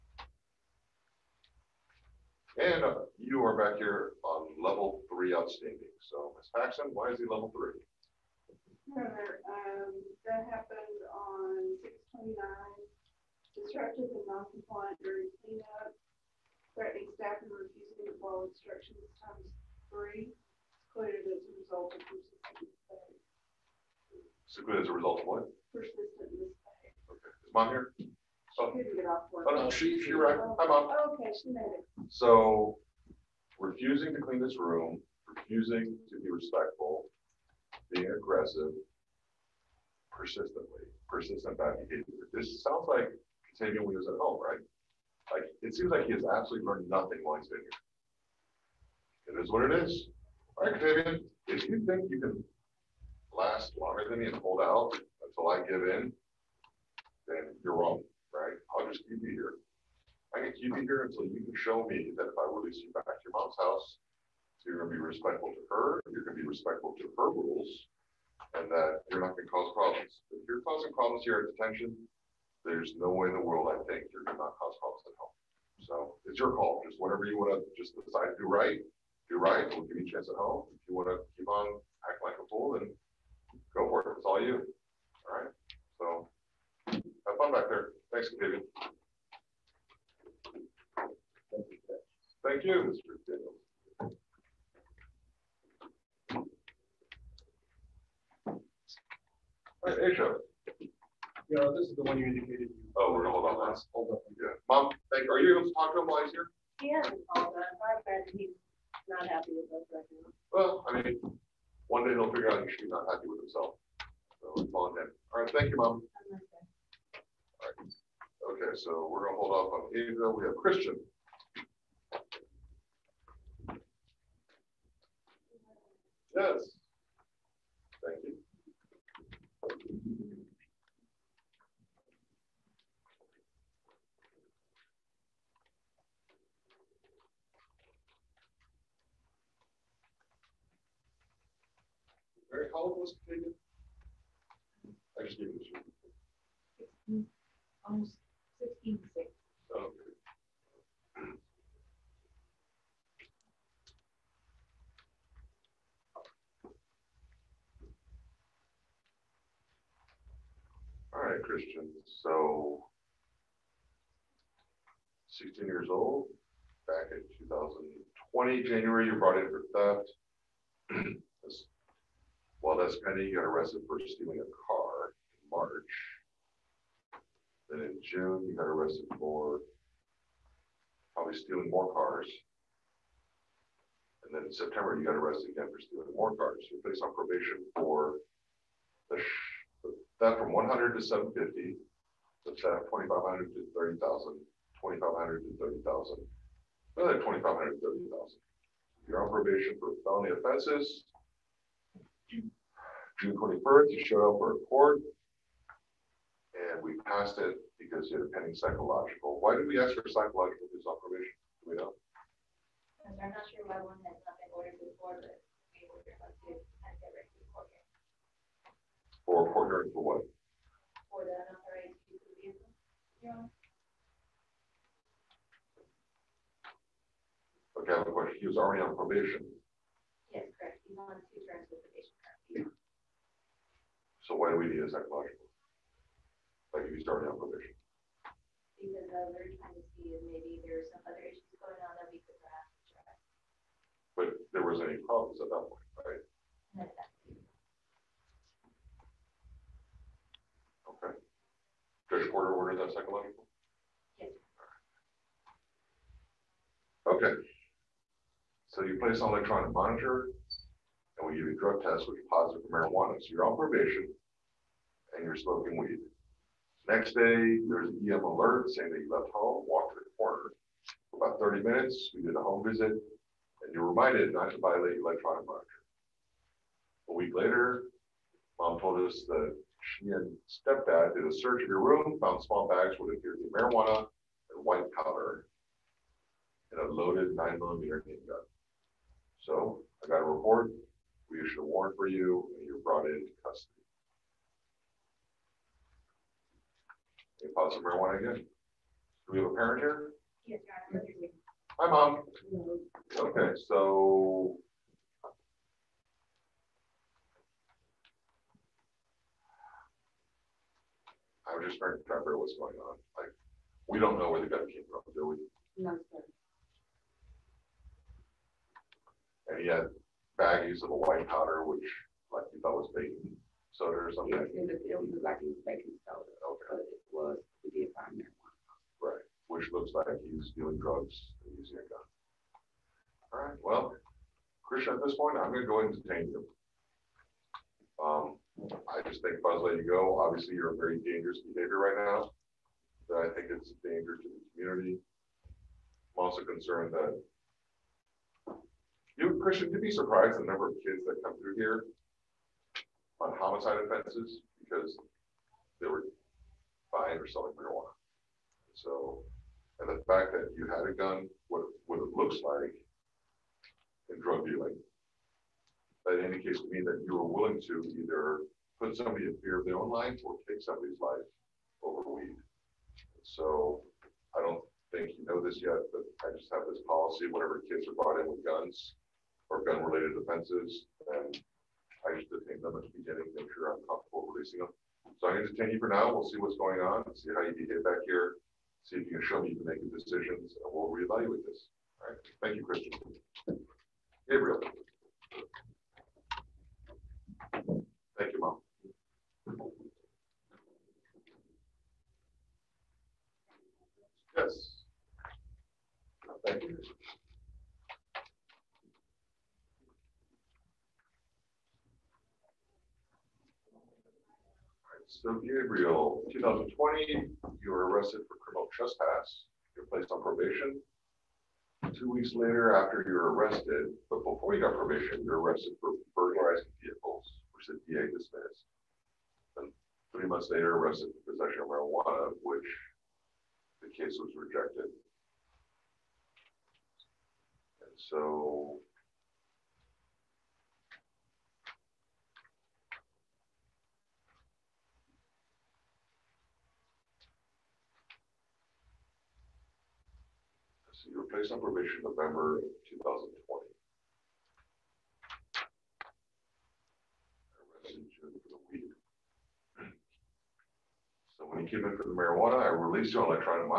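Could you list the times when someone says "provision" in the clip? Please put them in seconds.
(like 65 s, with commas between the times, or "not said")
211 s, 237 s.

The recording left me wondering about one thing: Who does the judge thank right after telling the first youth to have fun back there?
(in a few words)
Mr. Daniels.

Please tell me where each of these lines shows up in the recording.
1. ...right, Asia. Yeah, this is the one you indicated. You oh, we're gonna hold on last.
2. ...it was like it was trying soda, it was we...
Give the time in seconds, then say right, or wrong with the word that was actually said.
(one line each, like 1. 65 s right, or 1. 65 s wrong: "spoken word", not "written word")
1. 99 s right
2. 324 s wrong: "baking", not "trying".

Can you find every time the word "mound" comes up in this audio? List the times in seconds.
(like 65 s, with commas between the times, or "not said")
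not said.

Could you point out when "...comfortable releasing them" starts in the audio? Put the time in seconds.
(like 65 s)
383 s.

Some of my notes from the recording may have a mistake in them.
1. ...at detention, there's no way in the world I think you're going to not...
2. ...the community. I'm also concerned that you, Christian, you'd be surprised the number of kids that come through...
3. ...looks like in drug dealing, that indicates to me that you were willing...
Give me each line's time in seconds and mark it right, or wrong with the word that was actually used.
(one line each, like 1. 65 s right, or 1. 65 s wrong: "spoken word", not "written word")
1. 71 s right
2. 344 s right
3. 362 s right.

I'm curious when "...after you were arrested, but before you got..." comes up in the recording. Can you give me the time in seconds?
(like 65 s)
422 s.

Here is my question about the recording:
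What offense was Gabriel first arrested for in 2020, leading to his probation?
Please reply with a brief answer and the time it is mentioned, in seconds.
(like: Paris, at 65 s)
Criminal trespass, at 418 s.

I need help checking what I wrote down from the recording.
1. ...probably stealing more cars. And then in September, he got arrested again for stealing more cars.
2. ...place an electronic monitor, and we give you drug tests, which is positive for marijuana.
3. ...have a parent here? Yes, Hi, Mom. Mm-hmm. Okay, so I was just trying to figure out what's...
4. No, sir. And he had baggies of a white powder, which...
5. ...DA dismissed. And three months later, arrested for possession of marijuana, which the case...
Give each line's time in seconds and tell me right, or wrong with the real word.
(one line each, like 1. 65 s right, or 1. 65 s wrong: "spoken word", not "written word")
1. 181 s right
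2. 258 s right
3. 299 s right
4. 315 s right
5. 427 s right.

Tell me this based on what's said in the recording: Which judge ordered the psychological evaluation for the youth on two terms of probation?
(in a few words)
Judge Porter.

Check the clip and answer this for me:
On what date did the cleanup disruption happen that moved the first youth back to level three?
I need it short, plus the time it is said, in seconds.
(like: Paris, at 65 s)
6/29, at 11 s.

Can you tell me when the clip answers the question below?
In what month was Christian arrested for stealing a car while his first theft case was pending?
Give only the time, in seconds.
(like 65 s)
175 s.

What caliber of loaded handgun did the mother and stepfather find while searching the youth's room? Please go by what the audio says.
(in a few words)
9 millimeter.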